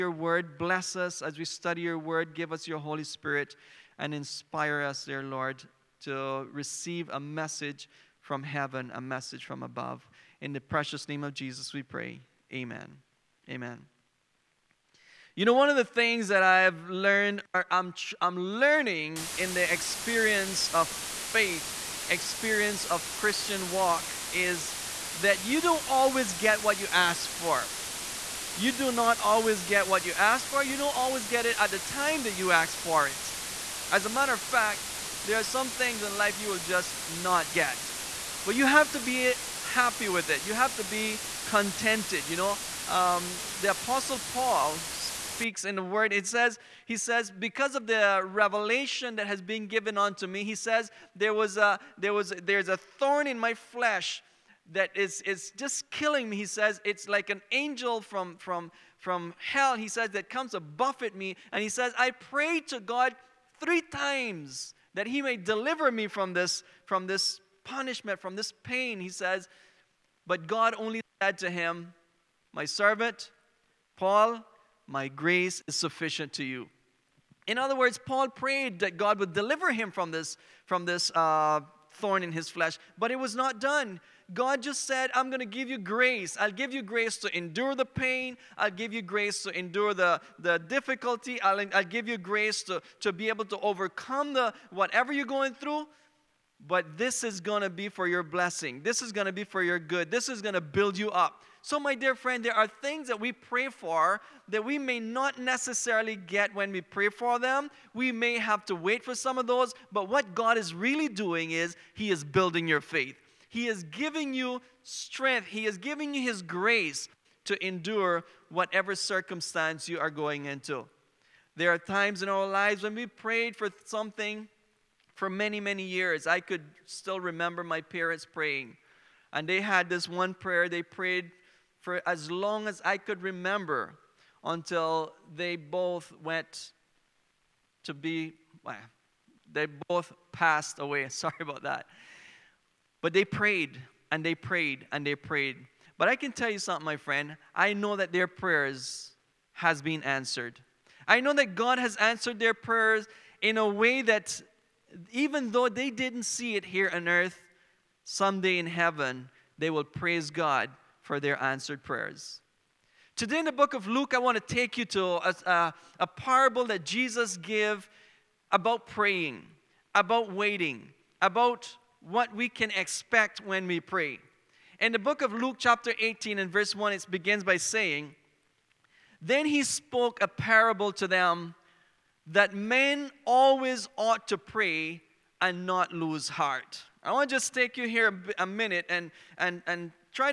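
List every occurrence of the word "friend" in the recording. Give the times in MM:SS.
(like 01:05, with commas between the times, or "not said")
01:42, 02:26.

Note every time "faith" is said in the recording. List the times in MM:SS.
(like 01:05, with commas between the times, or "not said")
00:21, 01:52.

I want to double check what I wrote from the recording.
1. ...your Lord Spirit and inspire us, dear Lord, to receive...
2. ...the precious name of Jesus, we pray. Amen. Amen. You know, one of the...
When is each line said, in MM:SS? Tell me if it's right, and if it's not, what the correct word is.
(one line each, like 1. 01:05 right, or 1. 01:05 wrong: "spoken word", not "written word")
1. 00:02 wrong: "Holy", not "Lord"
2. 00:10 right.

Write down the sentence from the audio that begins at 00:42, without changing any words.
You know, um, the Apostle Paul speaks in the word.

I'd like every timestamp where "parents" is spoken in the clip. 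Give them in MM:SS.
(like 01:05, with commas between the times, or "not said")
02:07.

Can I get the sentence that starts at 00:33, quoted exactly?
As a matter of fact, there are some things in life you will just not get.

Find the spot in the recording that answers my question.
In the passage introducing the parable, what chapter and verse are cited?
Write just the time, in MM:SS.
02:55.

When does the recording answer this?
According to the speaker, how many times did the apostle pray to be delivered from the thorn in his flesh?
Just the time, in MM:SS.
01:03.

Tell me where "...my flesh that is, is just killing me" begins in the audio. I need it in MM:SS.
00:53.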